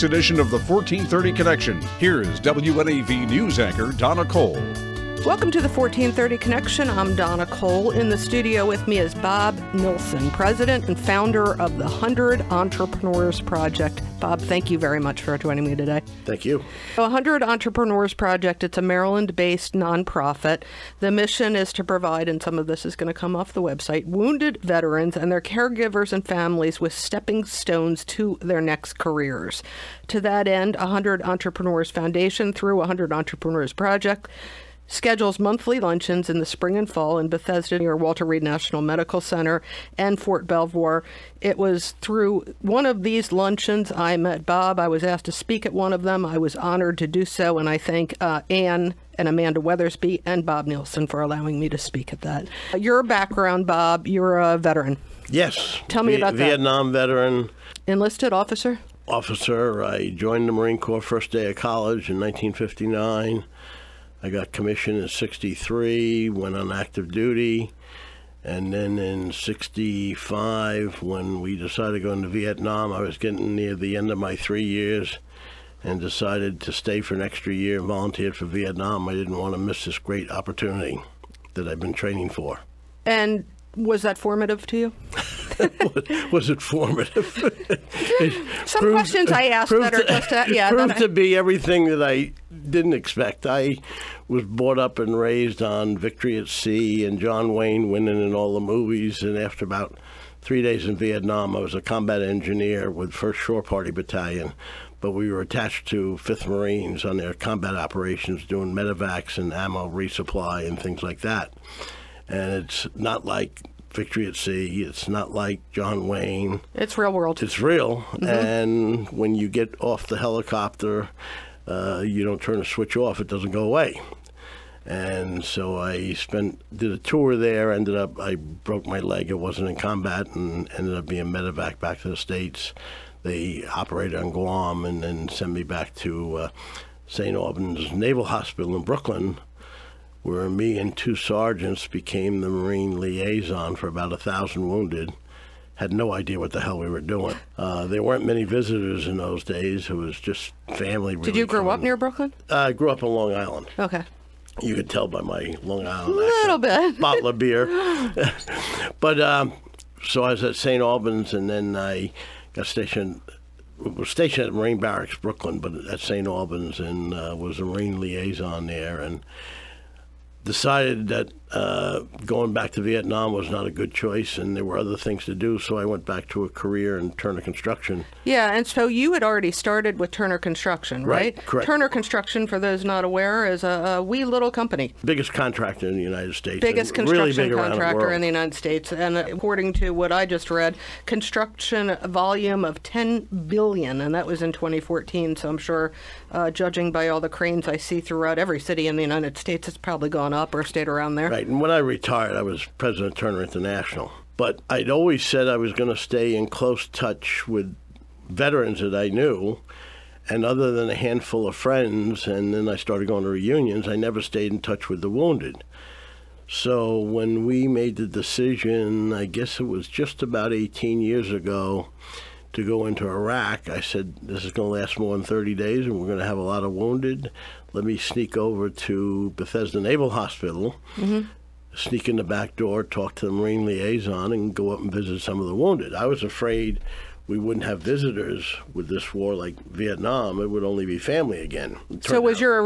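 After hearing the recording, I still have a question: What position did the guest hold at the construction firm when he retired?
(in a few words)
President of Turner International.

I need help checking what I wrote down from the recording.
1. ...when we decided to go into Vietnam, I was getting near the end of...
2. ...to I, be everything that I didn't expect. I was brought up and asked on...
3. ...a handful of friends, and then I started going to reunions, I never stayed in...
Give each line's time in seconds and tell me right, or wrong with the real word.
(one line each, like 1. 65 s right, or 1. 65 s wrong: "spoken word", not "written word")
1. 71 s right
2. 90 s wrong: "raised", not "asked"
3. 210 s right.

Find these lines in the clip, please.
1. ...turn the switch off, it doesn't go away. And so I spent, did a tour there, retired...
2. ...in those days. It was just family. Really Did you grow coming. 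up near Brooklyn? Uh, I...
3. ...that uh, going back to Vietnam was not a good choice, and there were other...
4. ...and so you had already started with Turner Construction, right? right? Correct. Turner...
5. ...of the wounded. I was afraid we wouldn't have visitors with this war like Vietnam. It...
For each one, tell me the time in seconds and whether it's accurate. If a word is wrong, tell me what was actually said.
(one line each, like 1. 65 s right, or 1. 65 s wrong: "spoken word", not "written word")
1. 122 s wrong: "ended", not "retired"
2. 149 s right
3. 171 s right
4. 178 s right
5. 235 s right.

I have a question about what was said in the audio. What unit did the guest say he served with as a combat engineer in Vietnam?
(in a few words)
1st Shore Party Battalion.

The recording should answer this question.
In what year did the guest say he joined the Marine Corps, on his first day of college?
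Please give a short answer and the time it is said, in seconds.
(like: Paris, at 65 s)
1959, at 62 s.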